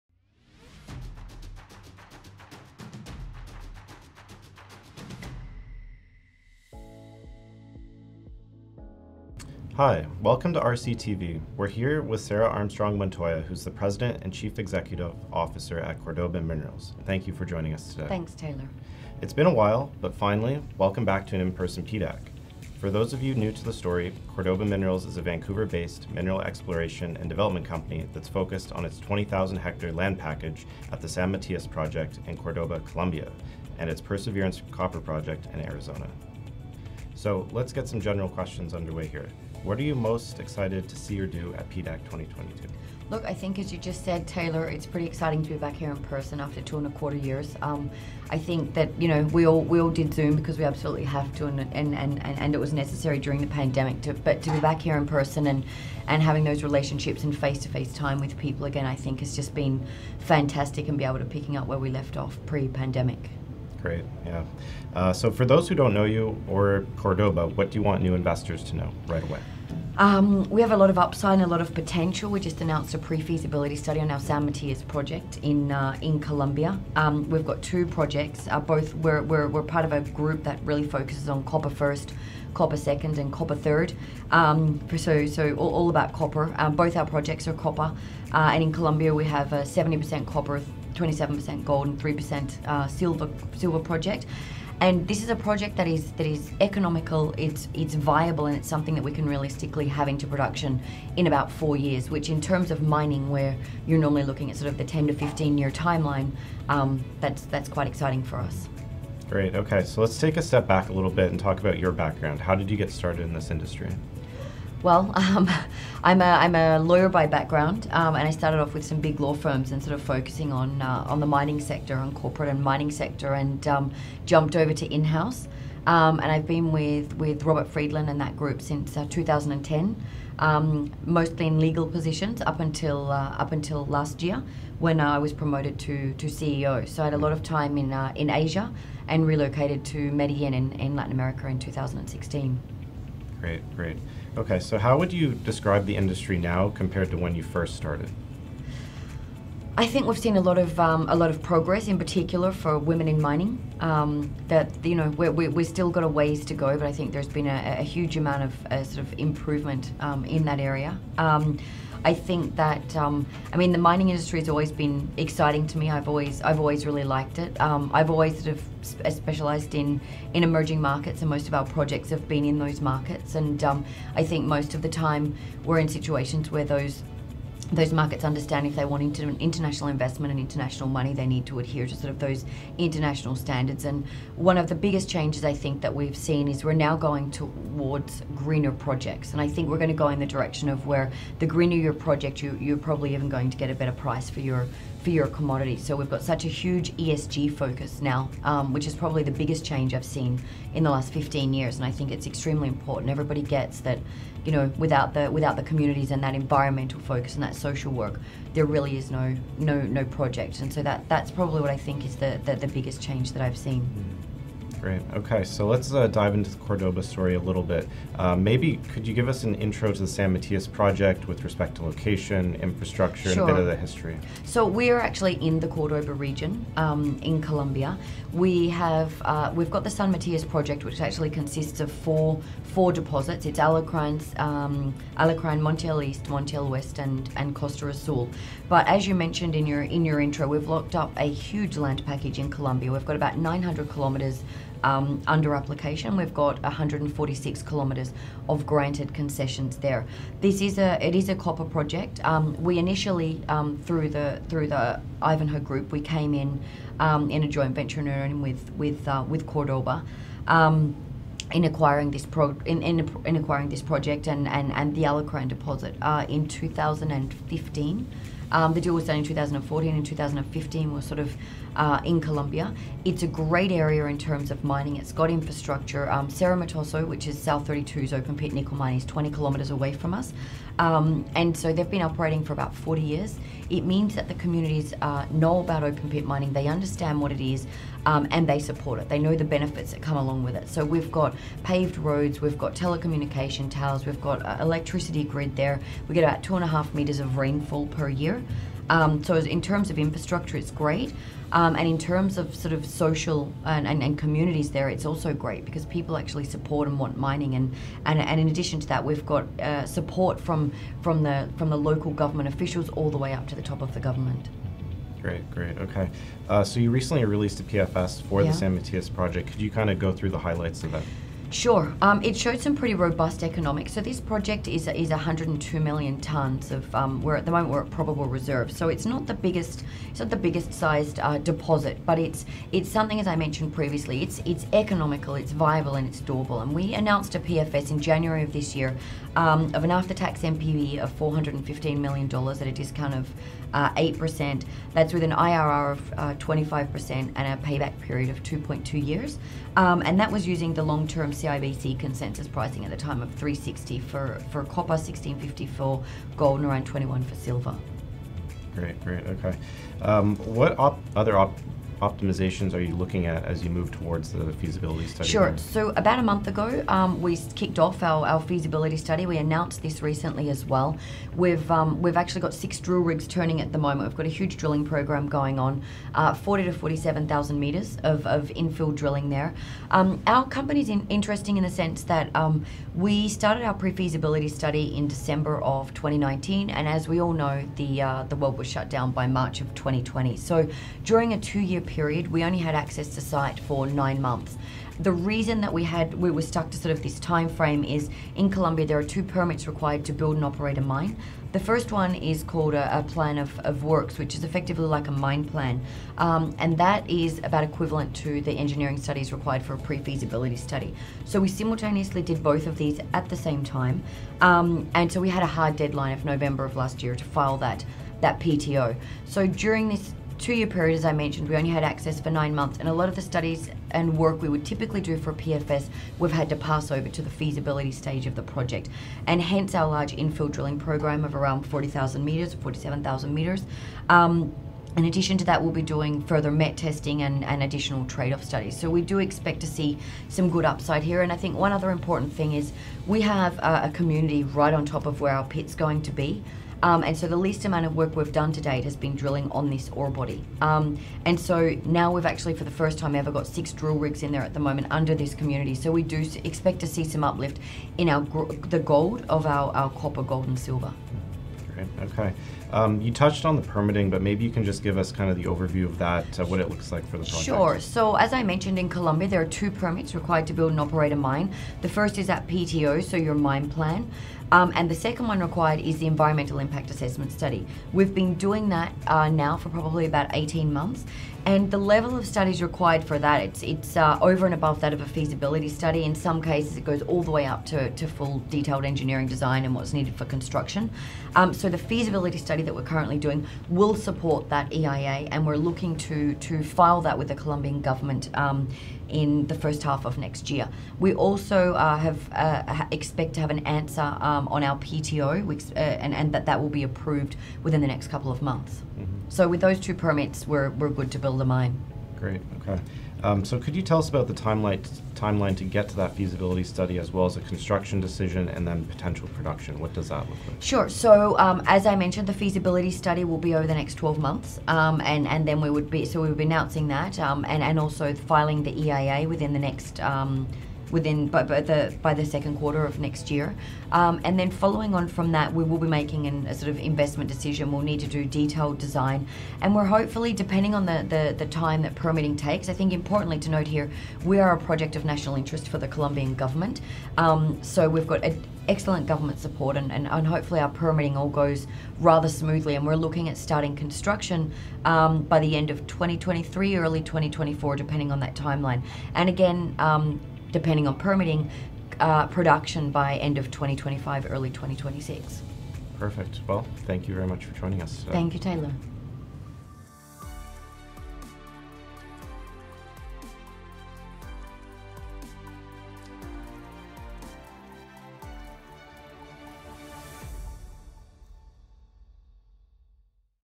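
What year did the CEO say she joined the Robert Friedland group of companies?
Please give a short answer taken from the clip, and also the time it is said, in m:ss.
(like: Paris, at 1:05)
2010, at 2:09.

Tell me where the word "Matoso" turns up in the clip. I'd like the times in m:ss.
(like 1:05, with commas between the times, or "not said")
4:36.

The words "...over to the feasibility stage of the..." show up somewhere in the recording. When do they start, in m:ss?
7:06.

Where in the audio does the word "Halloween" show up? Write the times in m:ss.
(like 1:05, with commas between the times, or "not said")
not said.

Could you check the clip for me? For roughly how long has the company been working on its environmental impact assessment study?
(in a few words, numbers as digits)
18 months.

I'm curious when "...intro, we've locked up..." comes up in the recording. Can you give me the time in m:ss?
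4:00.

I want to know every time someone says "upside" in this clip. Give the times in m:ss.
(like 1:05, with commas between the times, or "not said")
1:10, 7:20.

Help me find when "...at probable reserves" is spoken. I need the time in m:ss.
5:27.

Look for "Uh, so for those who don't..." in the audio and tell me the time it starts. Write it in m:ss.
1:04.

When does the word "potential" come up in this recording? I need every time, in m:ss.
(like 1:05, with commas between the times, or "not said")
1:11, 8:38.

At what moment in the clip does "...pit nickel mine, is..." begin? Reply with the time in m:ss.
4:38.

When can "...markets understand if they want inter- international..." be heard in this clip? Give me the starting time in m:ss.
2:57.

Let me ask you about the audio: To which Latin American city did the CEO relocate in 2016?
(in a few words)
Medellin.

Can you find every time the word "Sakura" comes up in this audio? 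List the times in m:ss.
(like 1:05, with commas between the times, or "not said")
not said.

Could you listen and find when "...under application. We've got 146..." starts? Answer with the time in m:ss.
4:05.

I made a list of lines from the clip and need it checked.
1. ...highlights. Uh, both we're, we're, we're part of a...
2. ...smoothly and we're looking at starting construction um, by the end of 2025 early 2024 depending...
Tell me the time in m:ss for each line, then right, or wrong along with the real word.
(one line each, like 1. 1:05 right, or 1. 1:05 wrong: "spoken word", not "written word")
1. 1:17 wrong: "projects", not "highlights"
2. 9:12 wrong: "2023", not "2025".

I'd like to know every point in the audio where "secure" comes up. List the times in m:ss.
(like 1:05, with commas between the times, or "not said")
not said.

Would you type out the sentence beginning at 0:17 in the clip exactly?
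Thank you for joining us today.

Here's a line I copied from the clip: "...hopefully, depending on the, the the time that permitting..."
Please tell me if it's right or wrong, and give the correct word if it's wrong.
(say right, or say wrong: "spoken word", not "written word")
right.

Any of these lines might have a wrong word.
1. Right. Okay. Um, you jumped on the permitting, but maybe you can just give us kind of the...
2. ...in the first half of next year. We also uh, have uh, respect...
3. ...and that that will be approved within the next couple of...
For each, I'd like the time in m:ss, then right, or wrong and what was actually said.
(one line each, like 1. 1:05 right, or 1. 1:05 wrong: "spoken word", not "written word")
1. 7:41 wrong: "touched", not "jumped"
2. 8:19 wrong: "expect", not "respect"
3. 8:26 right.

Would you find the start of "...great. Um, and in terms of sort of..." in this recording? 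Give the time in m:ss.
5:00.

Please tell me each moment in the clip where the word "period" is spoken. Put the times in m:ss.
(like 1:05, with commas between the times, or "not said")
5:48, 6:31, 7:00.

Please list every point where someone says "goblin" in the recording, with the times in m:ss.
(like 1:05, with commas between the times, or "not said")
not said.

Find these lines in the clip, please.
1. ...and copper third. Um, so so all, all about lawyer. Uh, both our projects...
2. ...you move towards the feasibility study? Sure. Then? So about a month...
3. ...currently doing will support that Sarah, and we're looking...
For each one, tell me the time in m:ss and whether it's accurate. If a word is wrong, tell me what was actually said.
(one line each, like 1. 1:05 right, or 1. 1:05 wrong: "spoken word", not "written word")
1. 1:23 wrong: "copper", not "lawyer"
2. 6:03 right
3. 8:12 wrong: "EIA", not "Sarah".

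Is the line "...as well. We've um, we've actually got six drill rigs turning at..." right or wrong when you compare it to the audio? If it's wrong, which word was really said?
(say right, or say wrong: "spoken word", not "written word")
right.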